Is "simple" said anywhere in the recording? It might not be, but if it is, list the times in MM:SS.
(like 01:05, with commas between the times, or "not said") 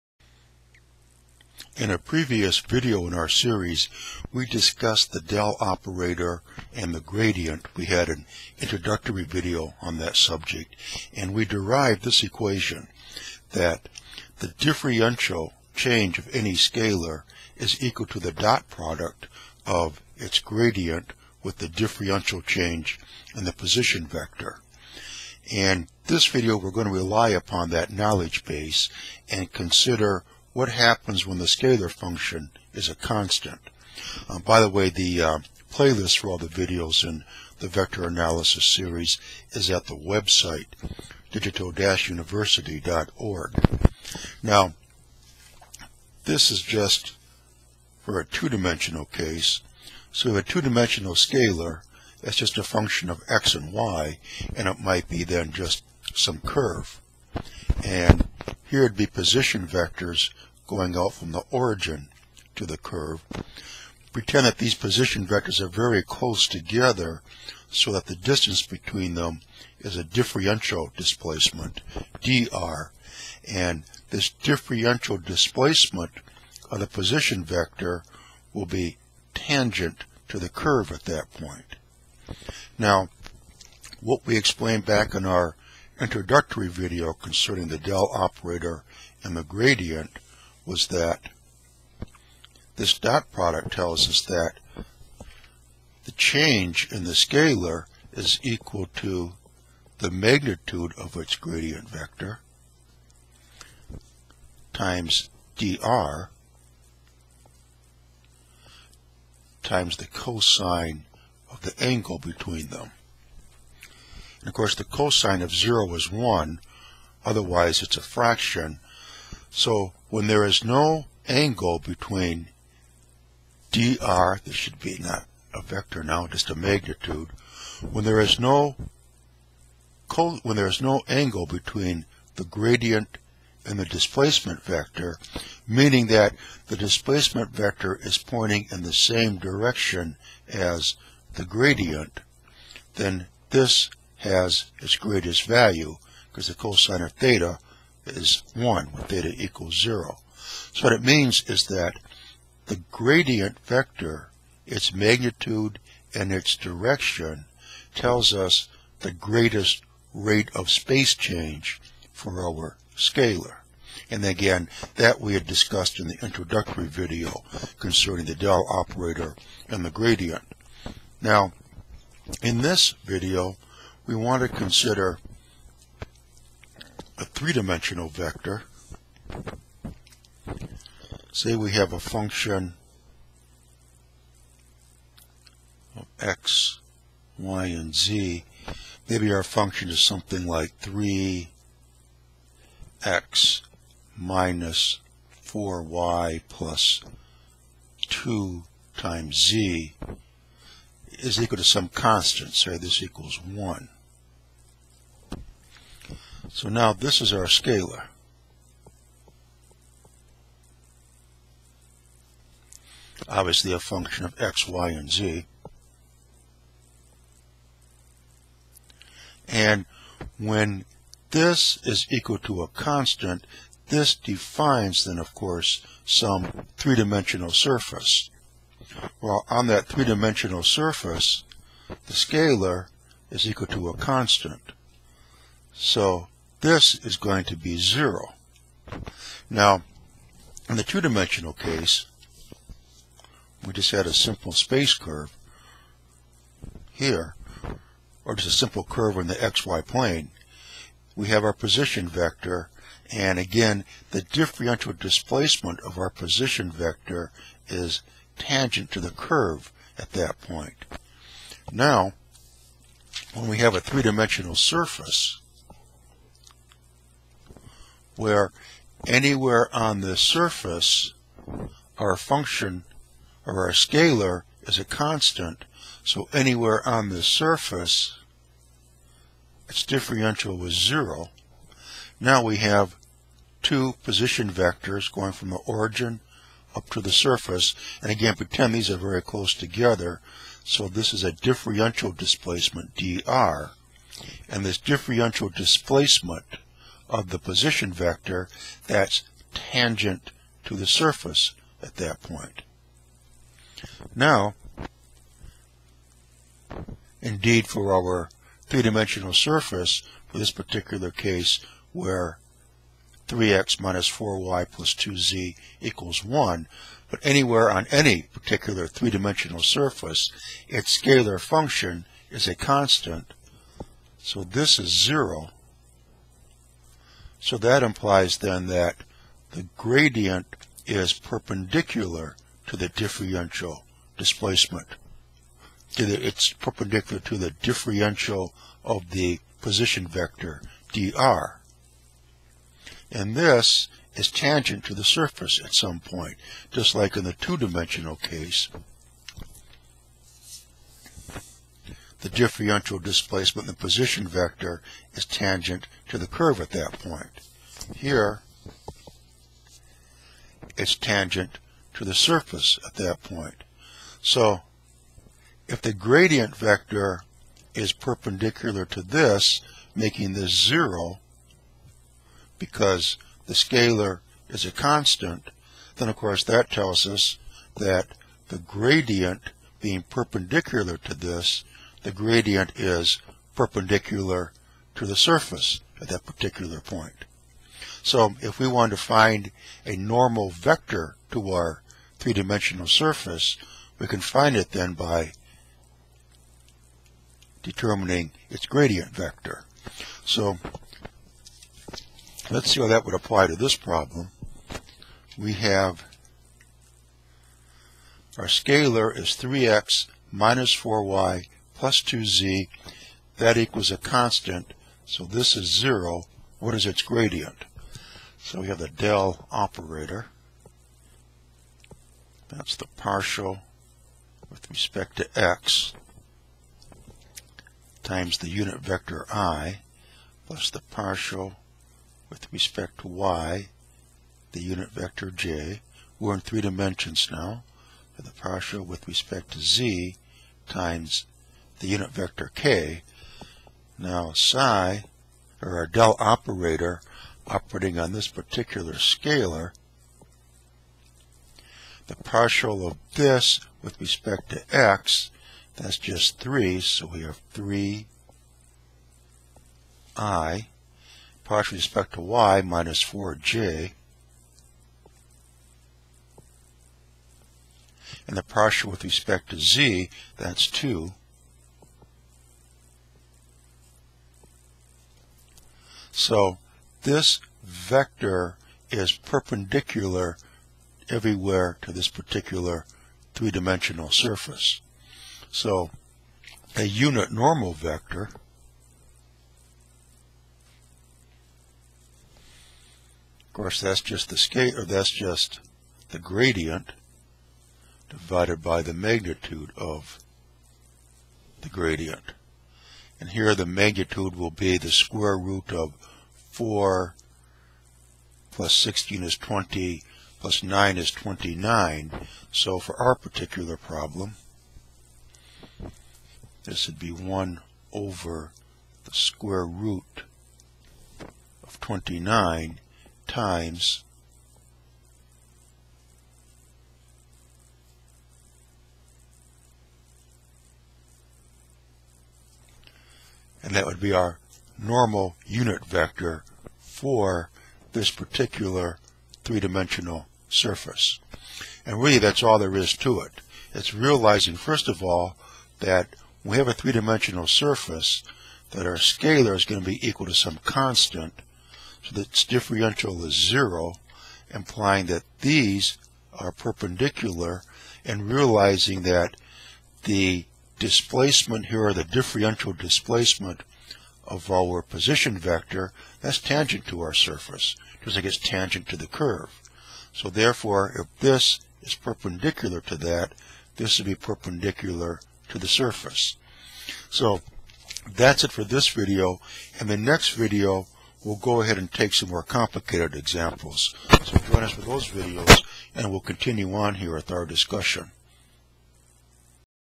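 04:04, 04:08.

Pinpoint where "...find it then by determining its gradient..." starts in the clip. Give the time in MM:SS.
06:34.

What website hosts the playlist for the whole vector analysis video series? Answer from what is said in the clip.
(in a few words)
digital-university.org.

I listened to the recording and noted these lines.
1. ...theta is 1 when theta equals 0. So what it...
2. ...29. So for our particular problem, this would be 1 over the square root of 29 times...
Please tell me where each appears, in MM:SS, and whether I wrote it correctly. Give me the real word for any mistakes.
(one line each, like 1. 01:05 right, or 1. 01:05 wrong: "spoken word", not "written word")
1. 02:27 right
2. 08:31 right.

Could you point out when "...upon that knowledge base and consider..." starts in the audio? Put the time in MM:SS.
00:27.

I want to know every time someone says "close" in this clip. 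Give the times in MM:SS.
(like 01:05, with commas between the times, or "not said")
01:06, 04:49.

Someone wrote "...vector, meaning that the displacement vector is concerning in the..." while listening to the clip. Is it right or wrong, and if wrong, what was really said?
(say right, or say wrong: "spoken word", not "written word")
wrong: "pointing", not "concerning".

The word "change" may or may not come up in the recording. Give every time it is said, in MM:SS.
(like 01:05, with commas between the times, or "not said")
00:15, 00:22, 01:36, 02:41.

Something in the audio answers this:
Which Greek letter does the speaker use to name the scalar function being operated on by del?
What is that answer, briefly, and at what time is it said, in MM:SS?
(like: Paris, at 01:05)
psi, at 07:24.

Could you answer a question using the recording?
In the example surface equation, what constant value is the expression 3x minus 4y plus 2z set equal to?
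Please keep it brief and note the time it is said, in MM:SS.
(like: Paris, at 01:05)
1, at 03:22.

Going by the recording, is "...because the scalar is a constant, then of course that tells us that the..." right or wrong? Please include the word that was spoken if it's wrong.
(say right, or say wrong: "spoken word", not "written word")
right.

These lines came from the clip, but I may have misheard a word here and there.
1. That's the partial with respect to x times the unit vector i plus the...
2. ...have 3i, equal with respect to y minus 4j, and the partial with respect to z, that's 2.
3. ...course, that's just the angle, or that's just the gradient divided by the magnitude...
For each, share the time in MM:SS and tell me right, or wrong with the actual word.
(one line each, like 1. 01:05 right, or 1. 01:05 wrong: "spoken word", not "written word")
1. 07:02 right
2. 07:37 wrong: "partial", not "equal"
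3. 08:13 wrong: "scale", not "angle".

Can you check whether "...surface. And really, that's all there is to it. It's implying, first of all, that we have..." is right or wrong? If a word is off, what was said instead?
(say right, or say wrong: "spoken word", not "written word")
wrong: "realizing", not "implying".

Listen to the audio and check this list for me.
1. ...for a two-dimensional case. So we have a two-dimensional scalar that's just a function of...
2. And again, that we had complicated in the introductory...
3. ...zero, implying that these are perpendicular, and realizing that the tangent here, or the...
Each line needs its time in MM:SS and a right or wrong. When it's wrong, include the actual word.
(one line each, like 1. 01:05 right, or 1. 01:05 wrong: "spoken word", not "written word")
1. 00:48 right
2. 02:44 wrong: "discussed", not "complicated"
3. 09:13 wrong: "displacement", not "tangent".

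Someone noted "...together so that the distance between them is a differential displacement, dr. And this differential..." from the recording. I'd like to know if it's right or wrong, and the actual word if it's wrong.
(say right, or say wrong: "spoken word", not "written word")
right.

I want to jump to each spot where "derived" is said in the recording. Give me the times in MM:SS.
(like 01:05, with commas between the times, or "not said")
00:11.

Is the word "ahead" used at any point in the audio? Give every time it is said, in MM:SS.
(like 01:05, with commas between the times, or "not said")
09:41.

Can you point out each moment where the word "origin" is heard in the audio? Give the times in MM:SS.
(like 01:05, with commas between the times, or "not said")
01:01, 04:45.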